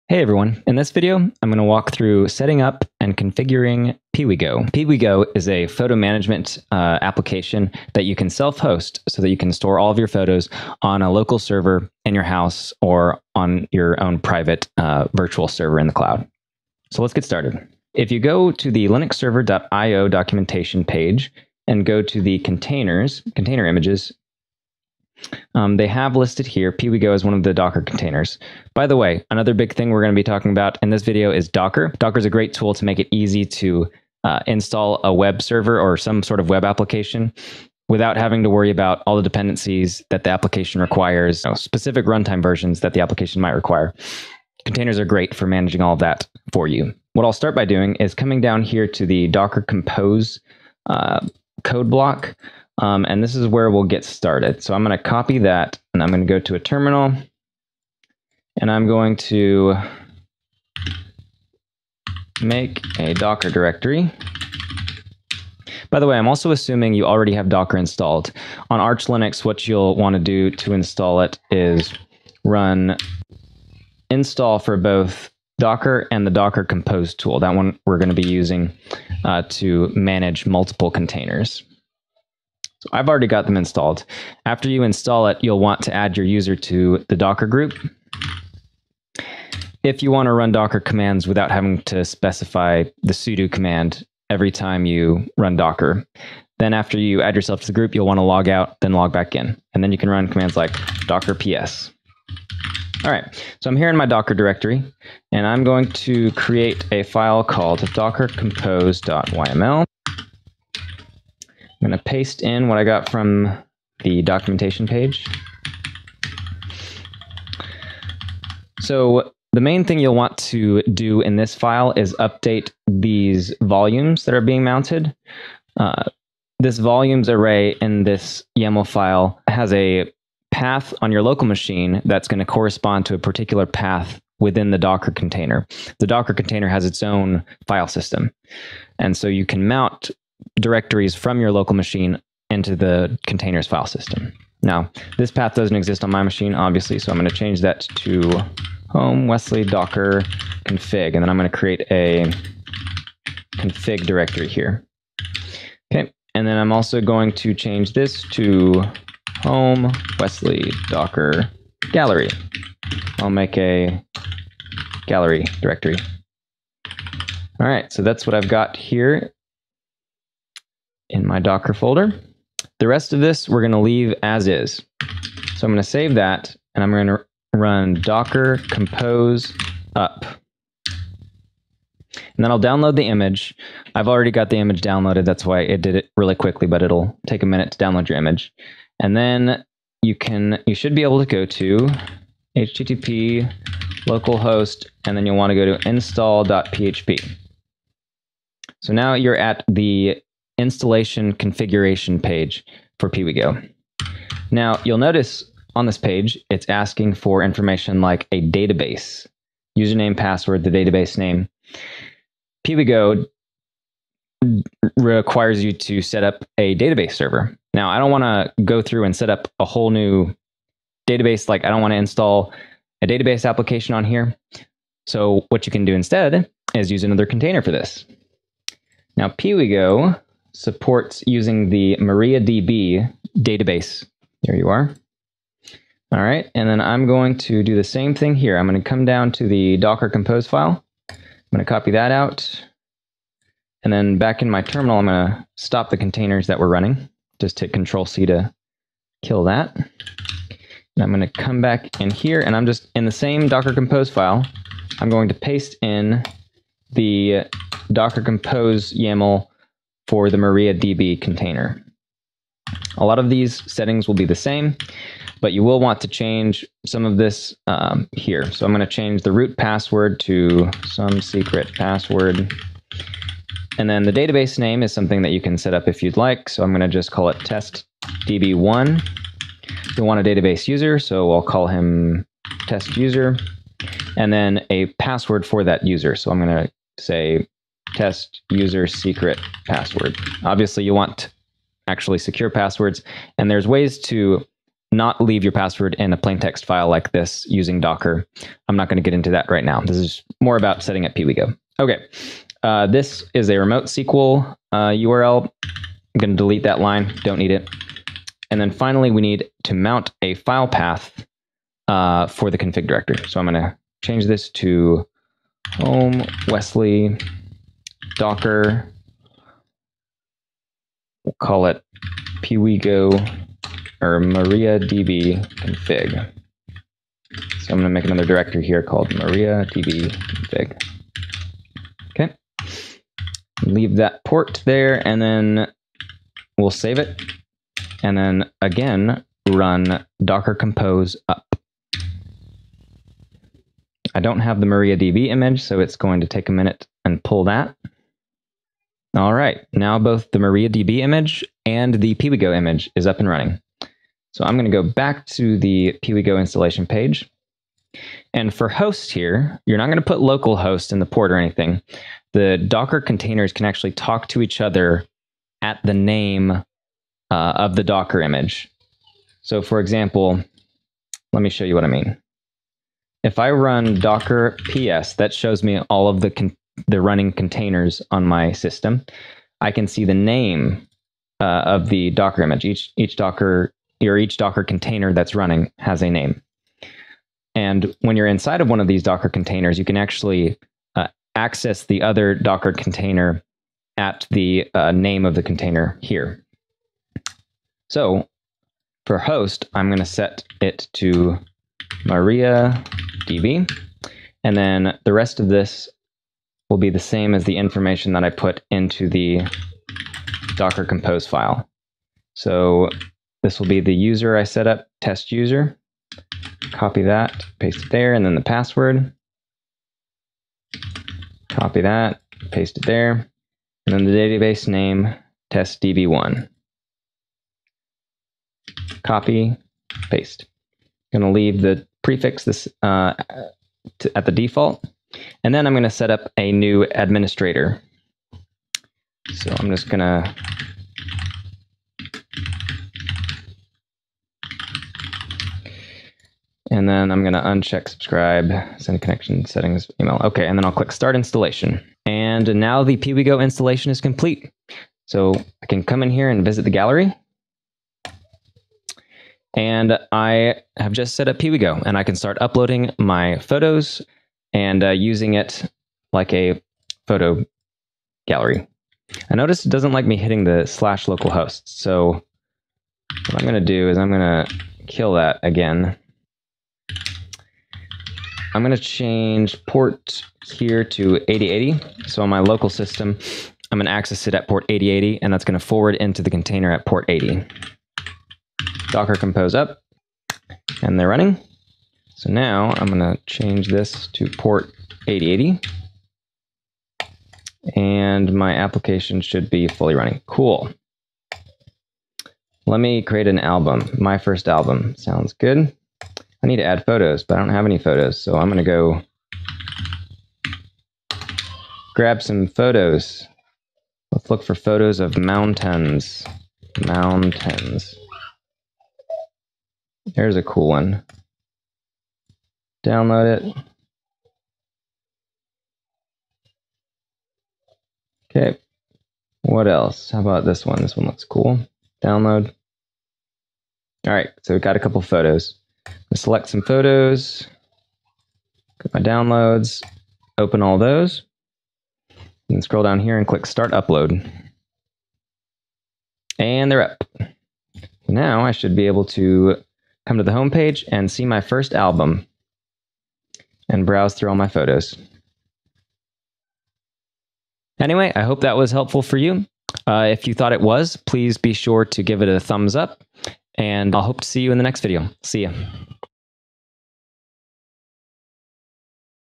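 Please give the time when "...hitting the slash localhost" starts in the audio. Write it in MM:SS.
07:50.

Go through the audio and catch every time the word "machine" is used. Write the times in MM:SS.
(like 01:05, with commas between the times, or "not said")
02:11, 02:21, 02:26.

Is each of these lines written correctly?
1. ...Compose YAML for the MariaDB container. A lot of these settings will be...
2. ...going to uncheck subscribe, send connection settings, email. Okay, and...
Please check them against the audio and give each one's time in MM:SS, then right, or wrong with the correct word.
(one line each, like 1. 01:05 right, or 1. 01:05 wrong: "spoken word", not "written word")
1. 04:18 right
2. 07:27 right.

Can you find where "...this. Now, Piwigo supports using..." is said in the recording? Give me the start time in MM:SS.
03:47.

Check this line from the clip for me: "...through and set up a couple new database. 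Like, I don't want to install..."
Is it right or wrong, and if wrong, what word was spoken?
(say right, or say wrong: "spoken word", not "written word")
wrong: "whole", not "couple".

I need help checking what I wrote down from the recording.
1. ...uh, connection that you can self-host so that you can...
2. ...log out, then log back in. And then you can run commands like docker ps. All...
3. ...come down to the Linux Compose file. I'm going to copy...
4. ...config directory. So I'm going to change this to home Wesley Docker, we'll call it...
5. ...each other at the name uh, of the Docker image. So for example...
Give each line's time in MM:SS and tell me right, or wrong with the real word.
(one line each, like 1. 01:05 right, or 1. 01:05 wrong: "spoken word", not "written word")
1. 00:06 wrong: "application", not "connection"
2. 01:38 right
3. 03:58 wrong: "Docker", not "Linux"
4. 05:12 right
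5. 06:04 right.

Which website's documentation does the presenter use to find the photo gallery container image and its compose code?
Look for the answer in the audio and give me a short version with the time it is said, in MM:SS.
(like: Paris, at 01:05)
linuxserver.io, at 00:18.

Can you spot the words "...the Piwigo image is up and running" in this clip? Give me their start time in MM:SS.
05:51.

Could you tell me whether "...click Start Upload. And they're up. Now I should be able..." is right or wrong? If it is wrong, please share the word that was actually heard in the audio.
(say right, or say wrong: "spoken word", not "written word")
right.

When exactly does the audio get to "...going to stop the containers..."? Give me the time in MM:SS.
04:05.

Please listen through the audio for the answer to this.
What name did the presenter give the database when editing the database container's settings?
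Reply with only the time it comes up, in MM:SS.
04:37.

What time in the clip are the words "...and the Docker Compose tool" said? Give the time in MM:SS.
01:16.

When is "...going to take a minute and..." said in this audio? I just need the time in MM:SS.
05:45.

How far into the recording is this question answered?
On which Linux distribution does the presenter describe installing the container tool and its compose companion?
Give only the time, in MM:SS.
01:08.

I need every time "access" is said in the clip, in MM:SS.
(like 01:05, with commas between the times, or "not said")
06:31, 08:03.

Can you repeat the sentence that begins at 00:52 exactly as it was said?
Um, and this is where we'll get started.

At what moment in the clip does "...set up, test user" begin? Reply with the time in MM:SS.
06:54.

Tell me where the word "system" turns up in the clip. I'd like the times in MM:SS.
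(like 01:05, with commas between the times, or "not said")
02:17, 02:23, 06:18, 08:02.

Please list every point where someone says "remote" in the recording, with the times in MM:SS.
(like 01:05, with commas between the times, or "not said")
05:03.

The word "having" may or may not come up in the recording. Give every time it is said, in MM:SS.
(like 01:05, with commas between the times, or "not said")
00:38, 01:31.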